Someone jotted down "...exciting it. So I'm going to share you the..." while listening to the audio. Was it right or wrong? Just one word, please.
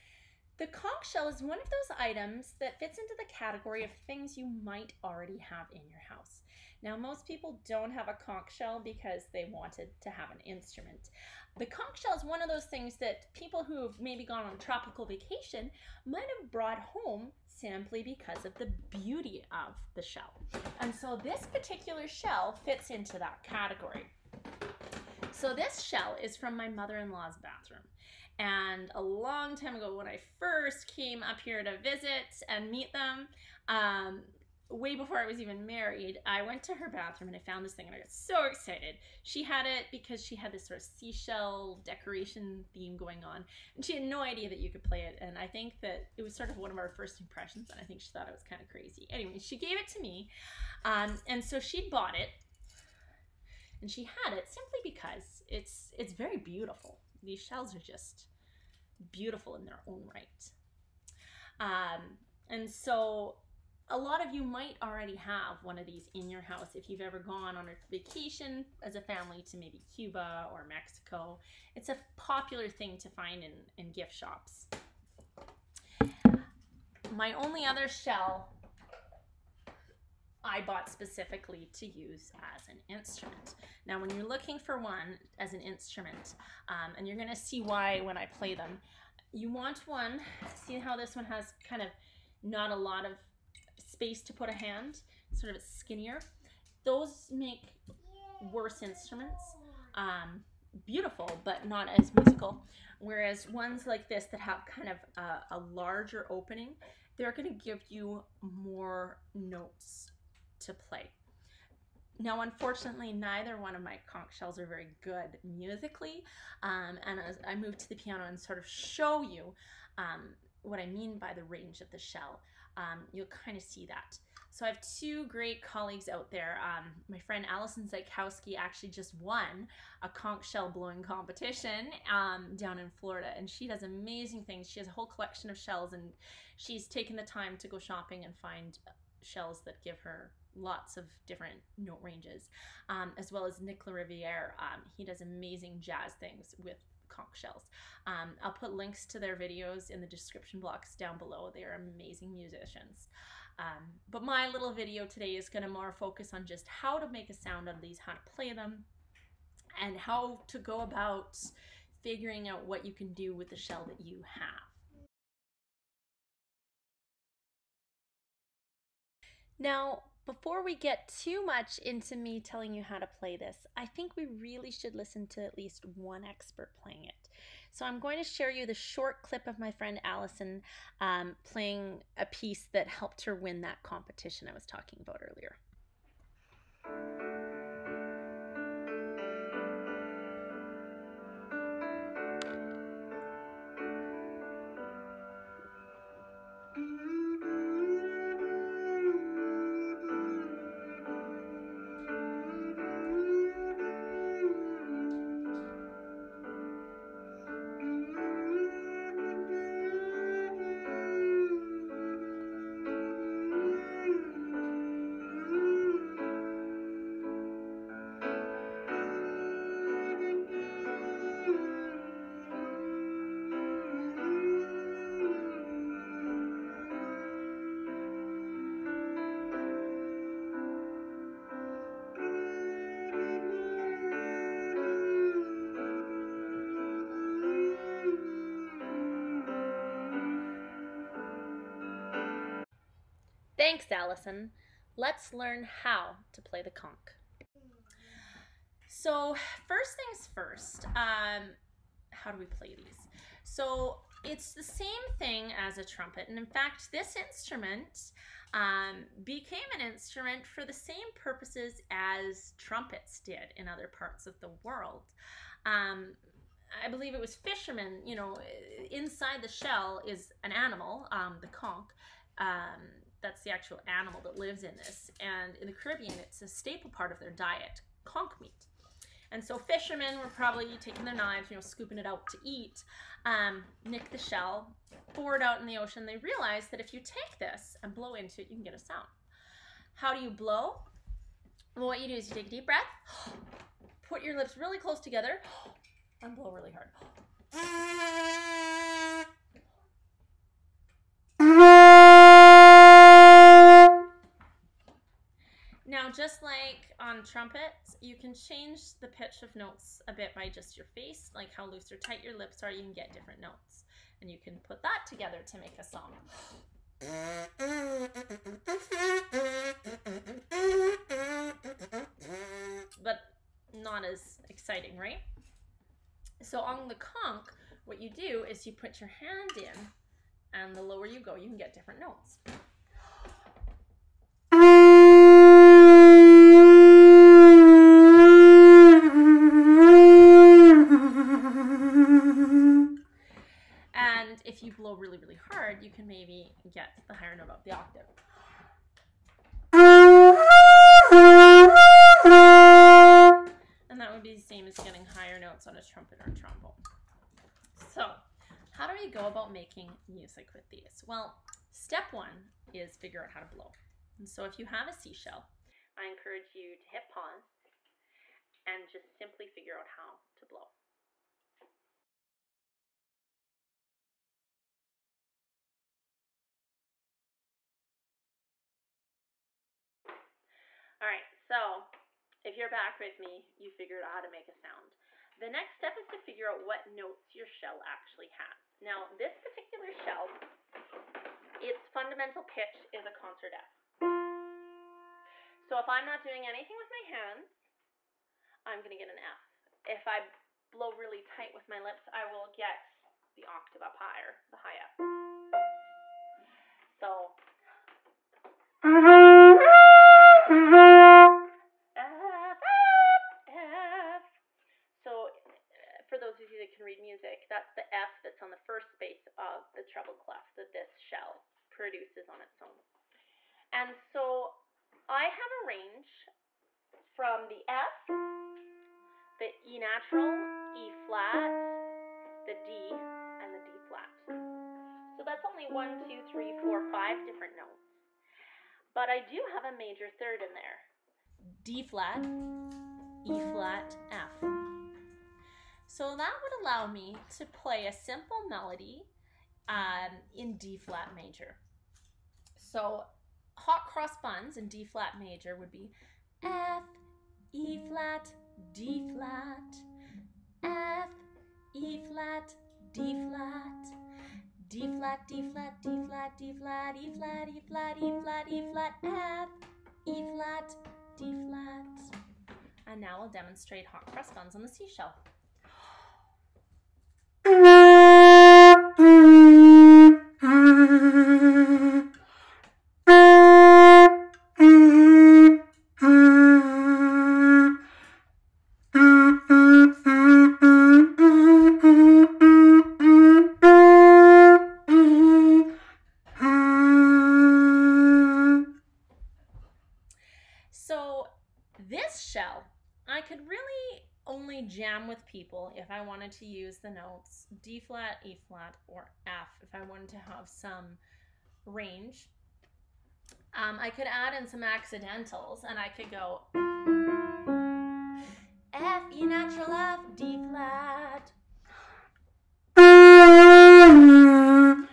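wrong.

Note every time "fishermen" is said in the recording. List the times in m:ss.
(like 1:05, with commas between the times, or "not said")
4:27, 4:39.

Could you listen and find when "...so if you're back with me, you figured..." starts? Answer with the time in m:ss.
6:21.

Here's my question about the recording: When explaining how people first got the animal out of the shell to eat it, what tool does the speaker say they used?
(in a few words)
Knives.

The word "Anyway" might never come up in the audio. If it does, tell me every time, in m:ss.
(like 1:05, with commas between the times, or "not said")
0:49.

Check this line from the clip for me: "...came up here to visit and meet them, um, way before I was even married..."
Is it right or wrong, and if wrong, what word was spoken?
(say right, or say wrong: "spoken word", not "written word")
right.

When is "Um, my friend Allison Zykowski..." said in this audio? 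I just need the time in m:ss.
2:06.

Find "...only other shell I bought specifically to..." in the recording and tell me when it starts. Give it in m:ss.
1:17.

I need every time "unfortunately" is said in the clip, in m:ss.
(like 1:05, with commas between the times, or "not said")
1:52.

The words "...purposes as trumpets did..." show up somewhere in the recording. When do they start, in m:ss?
4:21.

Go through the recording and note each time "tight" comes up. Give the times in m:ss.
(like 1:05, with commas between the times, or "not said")
5:11, 6:41.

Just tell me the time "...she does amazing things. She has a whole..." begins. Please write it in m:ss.
2:13.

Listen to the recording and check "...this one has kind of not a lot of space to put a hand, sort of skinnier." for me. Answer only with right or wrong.
right.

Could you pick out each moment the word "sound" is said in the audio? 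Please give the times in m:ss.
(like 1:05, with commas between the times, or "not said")
2:37, 4:48, 6:24.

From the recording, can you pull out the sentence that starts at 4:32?
Um, that's the actual animal that lives in this.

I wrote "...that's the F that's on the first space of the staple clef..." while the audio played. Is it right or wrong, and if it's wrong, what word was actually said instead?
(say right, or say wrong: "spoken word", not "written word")
wrong: "treble", not "staple".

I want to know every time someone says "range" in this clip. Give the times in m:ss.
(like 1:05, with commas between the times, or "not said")
2:01, 2:22, 7:05, 8:31.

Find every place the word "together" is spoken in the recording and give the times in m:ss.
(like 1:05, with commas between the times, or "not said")
4:54, 5:15.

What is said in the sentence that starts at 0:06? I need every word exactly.
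Now, most people don't have a conch shell because they wanted to have an instrument.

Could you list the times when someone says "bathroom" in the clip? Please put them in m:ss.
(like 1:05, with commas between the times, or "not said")
0:27, 0:36.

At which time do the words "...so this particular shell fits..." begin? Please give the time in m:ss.
0:20.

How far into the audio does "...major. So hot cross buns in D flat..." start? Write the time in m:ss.
7:31.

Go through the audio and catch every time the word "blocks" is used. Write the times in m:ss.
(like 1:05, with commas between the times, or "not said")
2:30.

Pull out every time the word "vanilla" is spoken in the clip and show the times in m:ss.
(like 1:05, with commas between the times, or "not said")
not said.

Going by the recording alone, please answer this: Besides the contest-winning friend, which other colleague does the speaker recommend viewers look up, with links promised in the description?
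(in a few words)
Nick LaRiviere.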